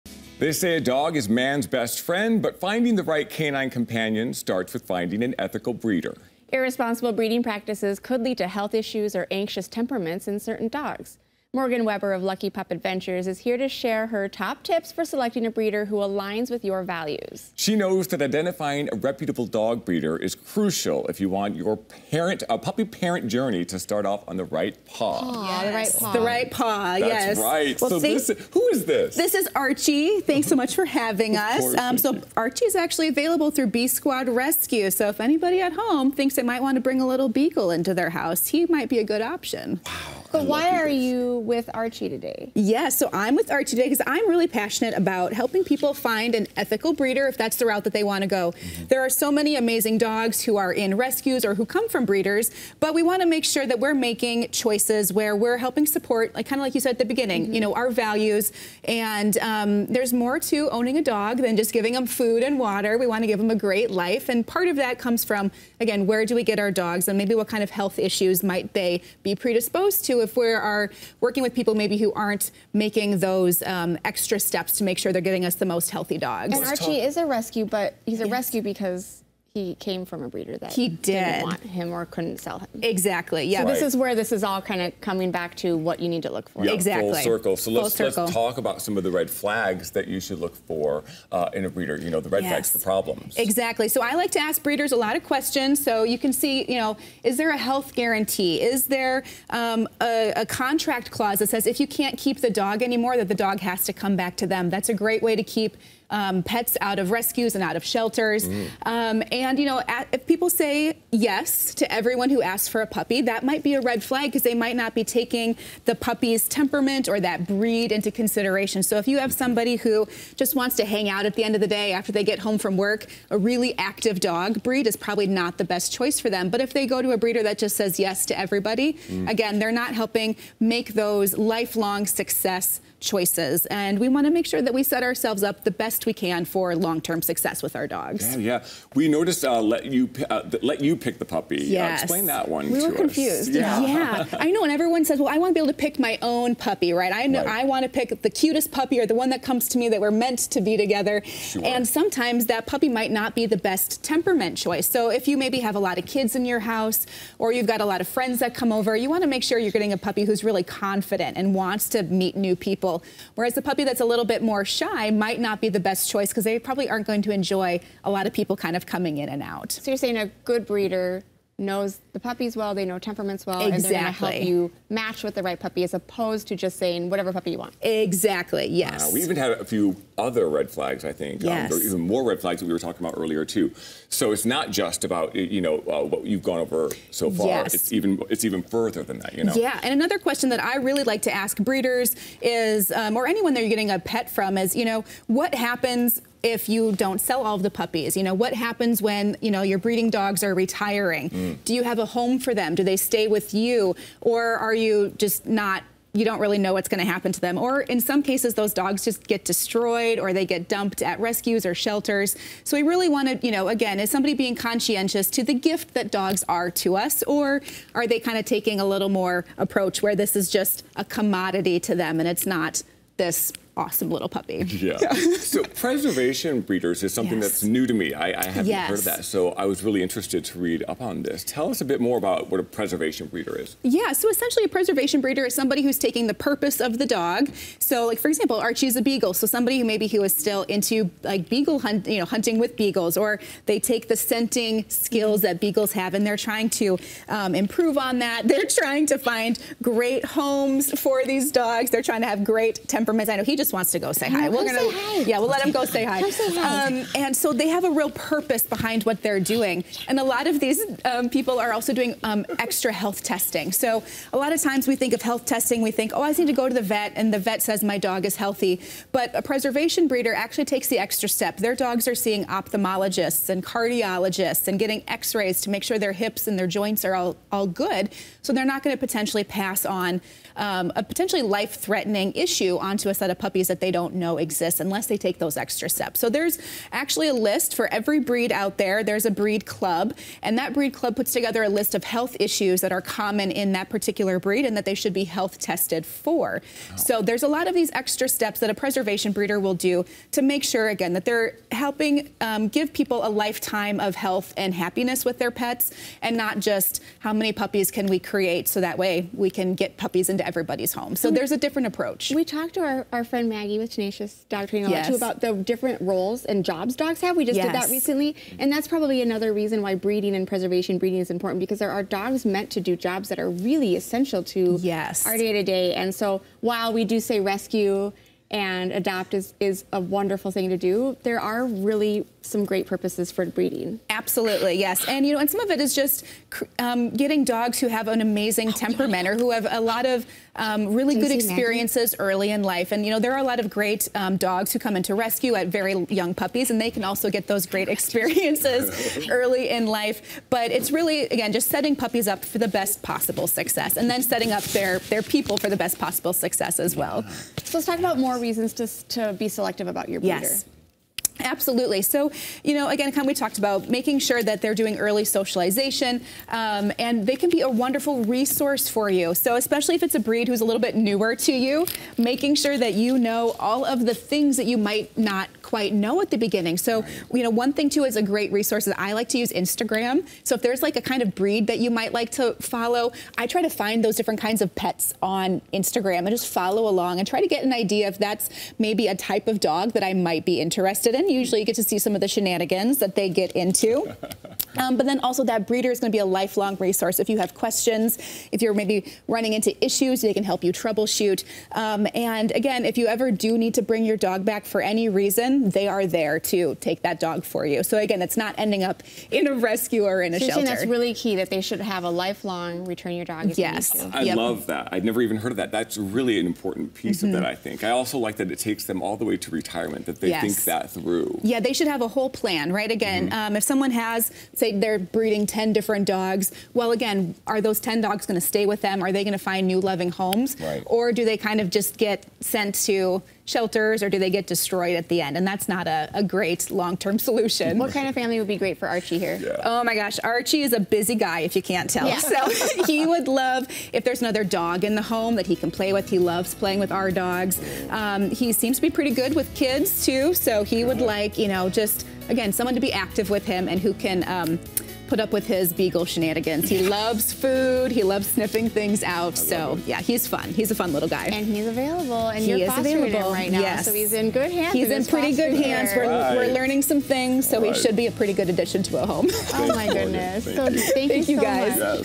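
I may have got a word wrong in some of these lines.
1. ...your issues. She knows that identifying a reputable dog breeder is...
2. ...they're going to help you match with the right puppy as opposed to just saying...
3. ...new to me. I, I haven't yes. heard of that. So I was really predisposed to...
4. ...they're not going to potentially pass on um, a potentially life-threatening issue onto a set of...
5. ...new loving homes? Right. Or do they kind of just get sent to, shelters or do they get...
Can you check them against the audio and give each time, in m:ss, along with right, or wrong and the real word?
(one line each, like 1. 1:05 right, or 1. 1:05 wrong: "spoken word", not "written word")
1. 0:16 wrong: "values", not "issues"
2. 2:53 right
3. 3:47 wrong: "interested", not "predisposed"
4. 4:38 right
5. 7:09 right.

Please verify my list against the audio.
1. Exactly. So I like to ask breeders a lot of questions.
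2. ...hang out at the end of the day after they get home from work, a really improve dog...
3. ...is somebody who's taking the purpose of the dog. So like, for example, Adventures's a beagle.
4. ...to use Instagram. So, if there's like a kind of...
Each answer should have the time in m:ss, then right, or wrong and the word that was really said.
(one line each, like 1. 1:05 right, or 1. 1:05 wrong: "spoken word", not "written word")
1. 1:33 right
2. 2:00 wrong: "active", not "improve"
3. 3:55 wrong: "Archie", not "Adventures"
4. 6:19 right.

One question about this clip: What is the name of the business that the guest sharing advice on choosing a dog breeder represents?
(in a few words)
Lucky Pup Adventures.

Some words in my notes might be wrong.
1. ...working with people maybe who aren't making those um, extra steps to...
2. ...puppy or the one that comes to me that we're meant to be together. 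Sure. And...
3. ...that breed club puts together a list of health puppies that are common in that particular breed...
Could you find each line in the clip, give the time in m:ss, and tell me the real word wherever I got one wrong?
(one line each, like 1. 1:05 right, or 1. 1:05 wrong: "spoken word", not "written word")
1. 1:11 right
2. 2:28 right
3. 4:50 wrong: "issues", not "puppies".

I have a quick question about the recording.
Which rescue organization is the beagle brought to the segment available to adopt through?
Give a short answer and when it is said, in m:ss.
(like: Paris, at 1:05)
Bee Squad Rescue, at 0:33.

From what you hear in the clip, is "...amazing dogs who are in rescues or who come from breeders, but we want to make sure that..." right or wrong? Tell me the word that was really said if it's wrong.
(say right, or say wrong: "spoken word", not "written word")
right.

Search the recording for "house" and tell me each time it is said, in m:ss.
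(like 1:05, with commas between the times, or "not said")
0:38, 2:36.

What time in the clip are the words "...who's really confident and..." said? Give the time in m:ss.
2:40.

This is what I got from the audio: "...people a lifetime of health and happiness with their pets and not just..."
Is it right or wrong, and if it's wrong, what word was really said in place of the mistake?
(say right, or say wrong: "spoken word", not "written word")
right.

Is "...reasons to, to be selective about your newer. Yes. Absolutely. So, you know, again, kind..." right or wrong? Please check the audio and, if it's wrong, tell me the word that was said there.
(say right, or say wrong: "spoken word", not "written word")
wrong: "breeder", not "newer".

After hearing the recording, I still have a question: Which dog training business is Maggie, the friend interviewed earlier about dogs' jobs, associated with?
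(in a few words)
Tenacious Dog Training.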